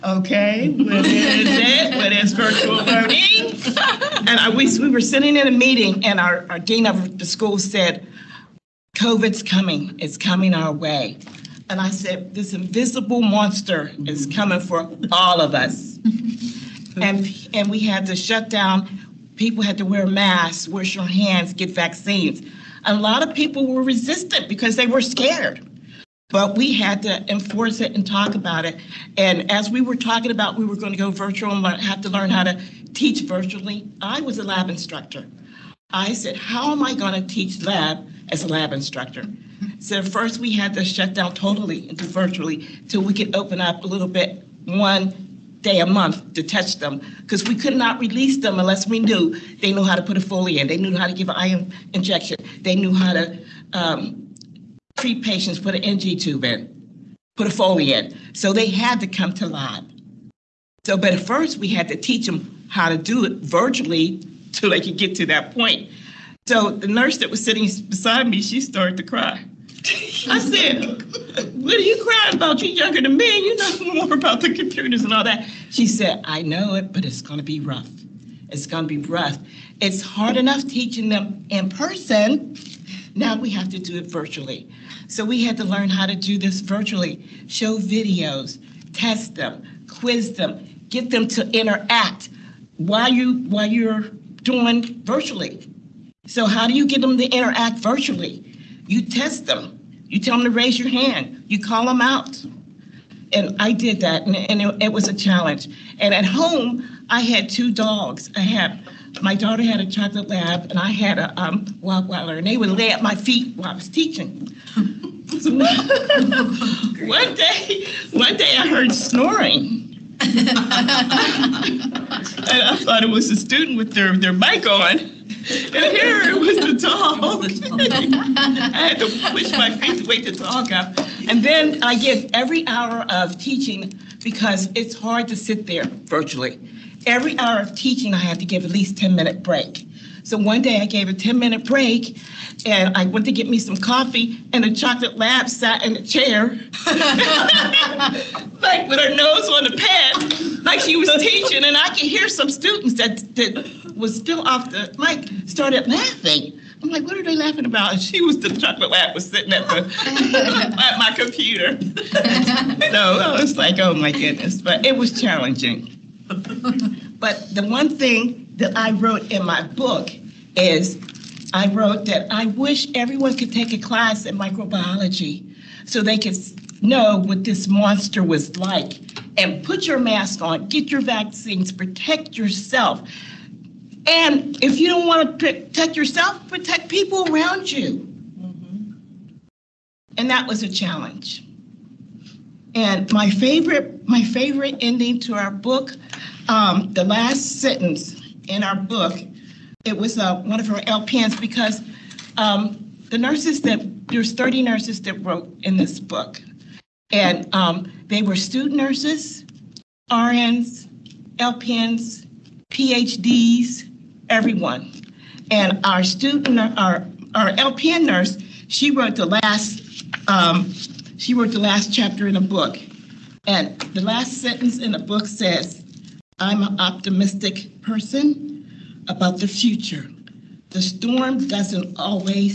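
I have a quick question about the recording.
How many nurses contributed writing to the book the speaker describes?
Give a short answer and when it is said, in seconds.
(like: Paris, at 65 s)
30, at 204 s.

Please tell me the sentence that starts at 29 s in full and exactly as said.
And as we were talking about, we were going to go virtual and have to learn how to teach virtually.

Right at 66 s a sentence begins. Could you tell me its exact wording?
So the nurse that was sitting beside me, she started to cry.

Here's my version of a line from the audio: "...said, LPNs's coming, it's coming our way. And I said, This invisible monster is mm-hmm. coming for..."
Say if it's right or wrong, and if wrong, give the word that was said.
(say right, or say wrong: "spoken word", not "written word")
wrong: "COVID", not "LPNs".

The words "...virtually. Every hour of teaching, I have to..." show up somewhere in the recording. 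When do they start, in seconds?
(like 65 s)
135 s.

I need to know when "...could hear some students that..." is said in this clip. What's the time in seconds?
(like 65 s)
151 s.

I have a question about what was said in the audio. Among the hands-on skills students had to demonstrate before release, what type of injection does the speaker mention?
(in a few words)
iron injection.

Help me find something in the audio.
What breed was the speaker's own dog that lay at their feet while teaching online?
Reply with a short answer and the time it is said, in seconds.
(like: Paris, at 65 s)
Rottweiler, at 111 s.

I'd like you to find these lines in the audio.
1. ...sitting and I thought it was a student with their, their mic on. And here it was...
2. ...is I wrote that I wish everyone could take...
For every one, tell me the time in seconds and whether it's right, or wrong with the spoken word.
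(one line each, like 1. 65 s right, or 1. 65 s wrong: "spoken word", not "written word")
1. 118 s wrong: "snoring", not "sitting"
2. 170 s right.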